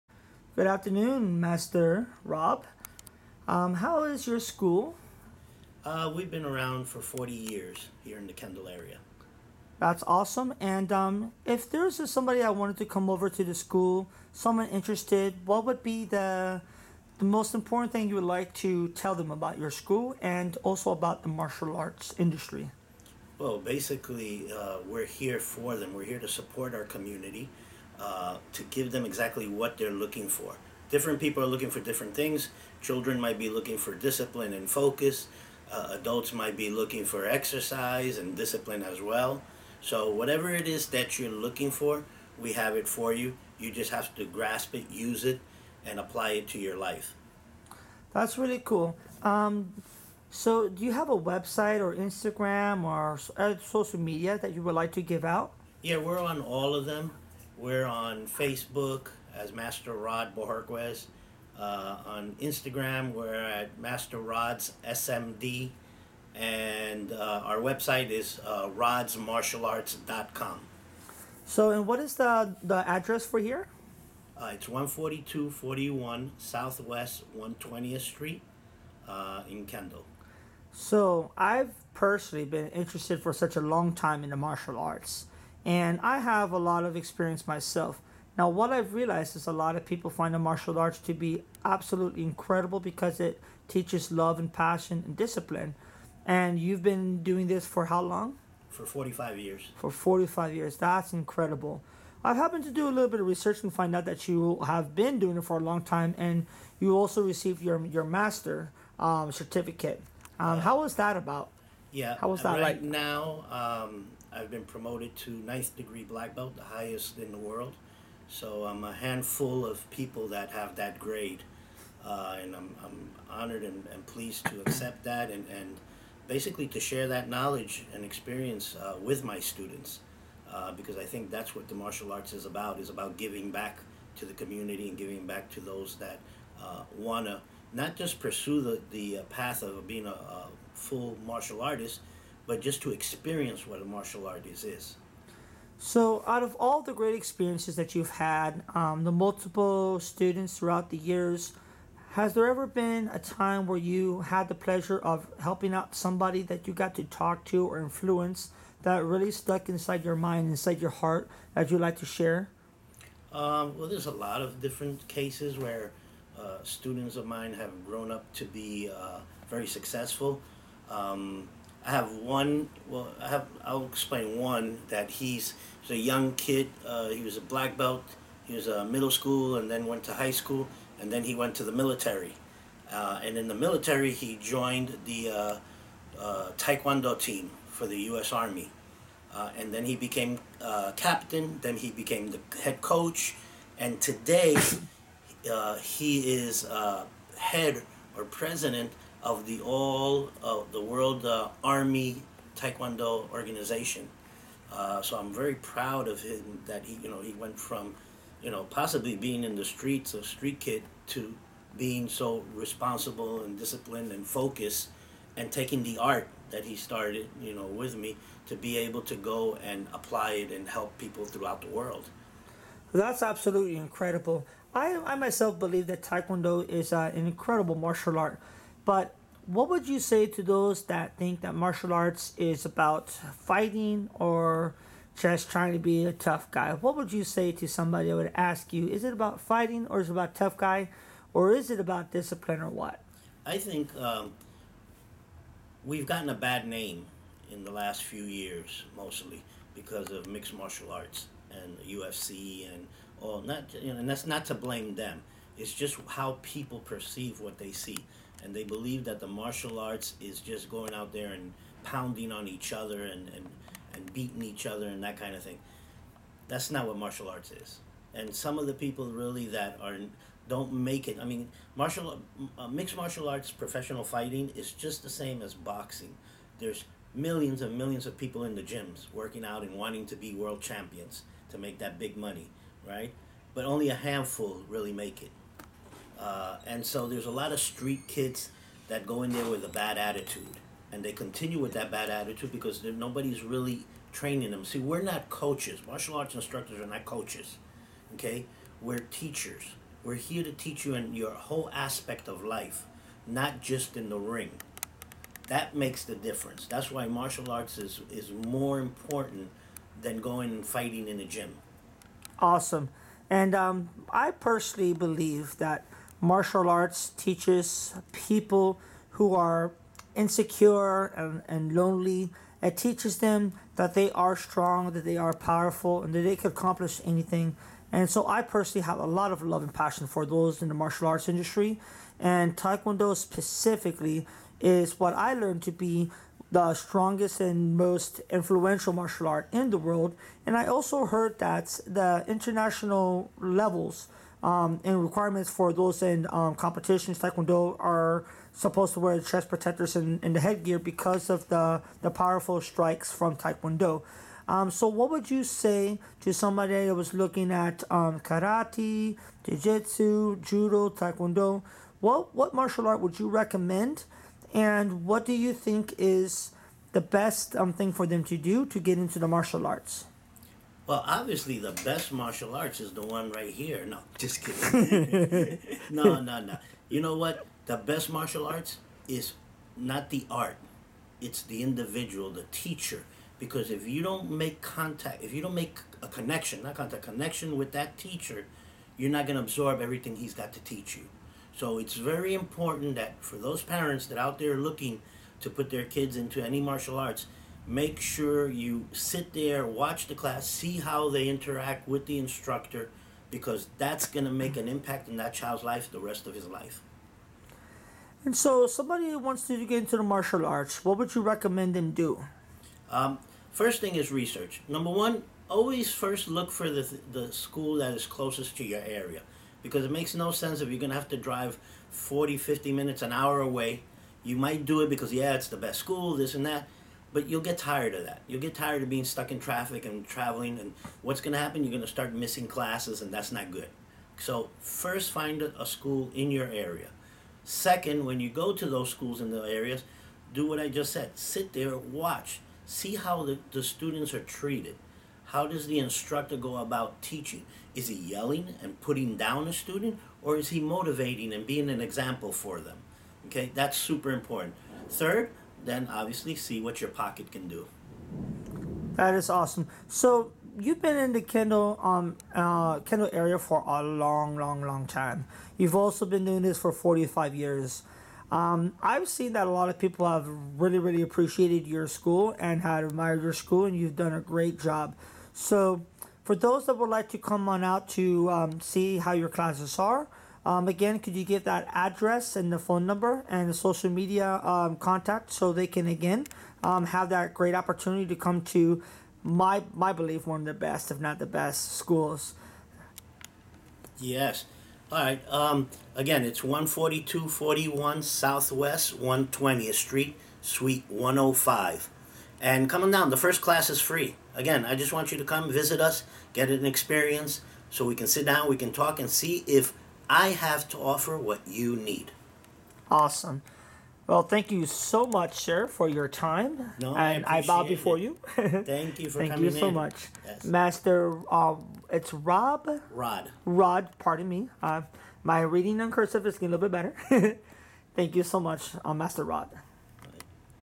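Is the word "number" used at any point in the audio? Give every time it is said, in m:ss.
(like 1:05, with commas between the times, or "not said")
6:54, 8:02.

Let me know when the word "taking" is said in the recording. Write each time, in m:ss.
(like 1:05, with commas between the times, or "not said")
3:35.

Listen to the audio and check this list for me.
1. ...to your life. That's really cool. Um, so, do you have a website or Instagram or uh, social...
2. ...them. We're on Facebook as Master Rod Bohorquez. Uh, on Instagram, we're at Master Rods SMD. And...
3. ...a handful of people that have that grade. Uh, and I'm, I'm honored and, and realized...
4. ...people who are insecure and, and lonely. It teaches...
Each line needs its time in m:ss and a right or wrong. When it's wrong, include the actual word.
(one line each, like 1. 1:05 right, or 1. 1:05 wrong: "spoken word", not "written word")
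1. 0:46 right
2. 0:56 right
3. 1:58 wrong: "pleased", not "realized"
4. 5:18 right.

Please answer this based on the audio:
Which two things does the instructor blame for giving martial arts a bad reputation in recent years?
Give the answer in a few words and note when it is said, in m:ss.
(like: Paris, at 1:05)
Mixed martial arts and UFC, at 4:10.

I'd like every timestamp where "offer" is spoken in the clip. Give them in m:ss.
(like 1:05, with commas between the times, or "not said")
8:30.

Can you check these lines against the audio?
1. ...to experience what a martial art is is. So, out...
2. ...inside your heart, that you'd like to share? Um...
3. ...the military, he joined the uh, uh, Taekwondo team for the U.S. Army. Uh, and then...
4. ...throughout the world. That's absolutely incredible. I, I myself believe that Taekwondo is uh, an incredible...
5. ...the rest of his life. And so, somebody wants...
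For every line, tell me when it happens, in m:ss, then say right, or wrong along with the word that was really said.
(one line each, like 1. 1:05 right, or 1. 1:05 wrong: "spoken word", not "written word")
1. 2:22 right
2. 2:40 right
3. 3:03 right
4. 3:41 right
5. 6:45 right.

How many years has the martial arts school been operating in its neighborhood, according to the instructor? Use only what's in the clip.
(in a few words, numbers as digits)
40.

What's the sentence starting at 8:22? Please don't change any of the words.
And coming down, the first class is free.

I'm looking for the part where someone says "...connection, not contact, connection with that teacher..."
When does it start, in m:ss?
6:26.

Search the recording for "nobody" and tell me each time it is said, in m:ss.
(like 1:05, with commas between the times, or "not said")
4:52.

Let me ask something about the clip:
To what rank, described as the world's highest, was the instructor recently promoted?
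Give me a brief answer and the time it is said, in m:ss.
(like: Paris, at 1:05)
Ninth degree black belt, at 1:55.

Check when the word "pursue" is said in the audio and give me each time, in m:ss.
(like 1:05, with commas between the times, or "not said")
2:18.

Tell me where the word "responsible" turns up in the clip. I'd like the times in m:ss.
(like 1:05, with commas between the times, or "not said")
3:32.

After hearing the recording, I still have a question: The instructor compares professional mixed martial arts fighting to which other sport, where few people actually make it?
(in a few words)
Boxing.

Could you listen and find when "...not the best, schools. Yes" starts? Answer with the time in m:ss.
8:10.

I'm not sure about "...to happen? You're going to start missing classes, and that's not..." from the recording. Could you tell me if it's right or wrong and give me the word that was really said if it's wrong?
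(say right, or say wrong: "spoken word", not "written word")
right.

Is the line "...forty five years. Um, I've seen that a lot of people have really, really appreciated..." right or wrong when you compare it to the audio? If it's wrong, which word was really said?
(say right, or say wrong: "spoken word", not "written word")
right.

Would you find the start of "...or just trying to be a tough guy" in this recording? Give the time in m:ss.
3:54.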